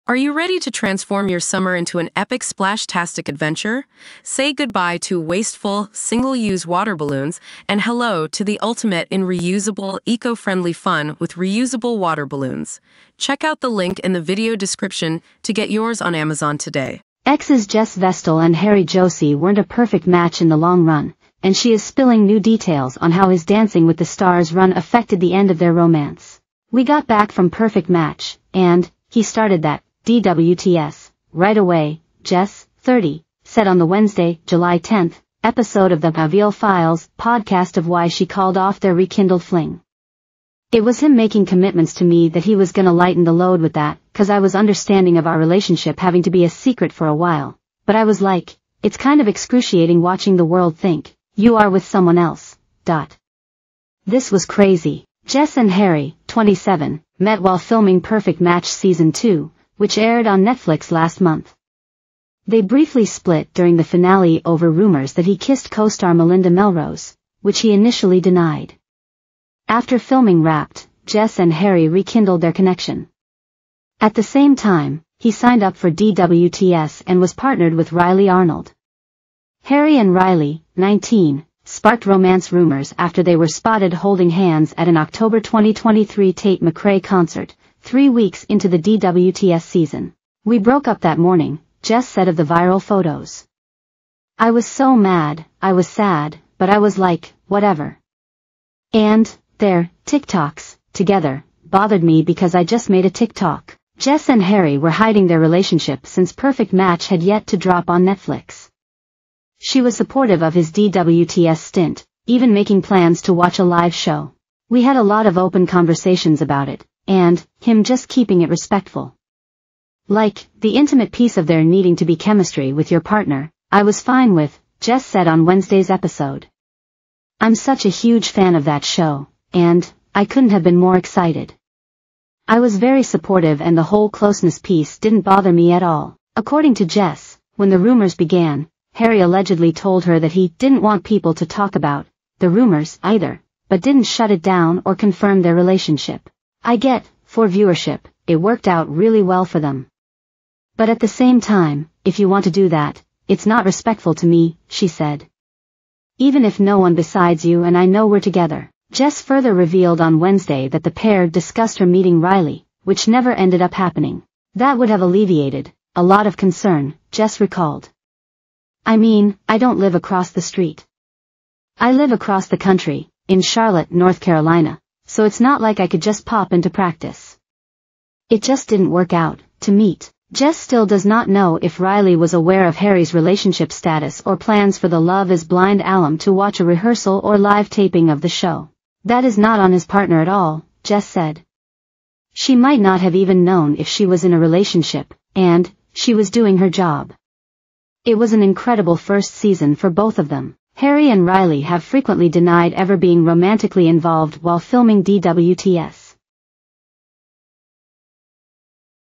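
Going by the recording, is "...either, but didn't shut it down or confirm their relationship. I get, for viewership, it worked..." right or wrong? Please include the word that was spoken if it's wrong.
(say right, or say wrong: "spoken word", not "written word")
right.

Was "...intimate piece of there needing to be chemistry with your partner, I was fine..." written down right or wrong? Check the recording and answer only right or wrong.
right.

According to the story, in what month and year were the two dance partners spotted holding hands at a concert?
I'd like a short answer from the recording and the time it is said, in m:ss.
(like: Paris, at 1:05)
October 2023, at 1:24.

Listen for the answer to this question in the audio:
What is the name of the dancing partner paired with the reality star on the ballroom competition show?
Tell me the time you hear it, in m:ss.
1:17.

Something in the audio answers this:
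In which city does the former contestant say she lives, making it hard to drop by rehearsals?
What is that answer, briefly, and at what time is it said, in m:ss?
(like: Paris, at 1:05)
Charlotte, North Carolina, at 2:53.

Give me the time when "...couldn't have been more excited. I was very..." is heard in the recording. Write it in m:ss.
2:10.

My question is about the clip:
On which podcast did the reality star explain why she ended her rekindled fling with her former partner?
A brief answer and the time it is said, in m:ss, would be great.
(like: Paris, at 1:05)
Viall Files, at 0:36.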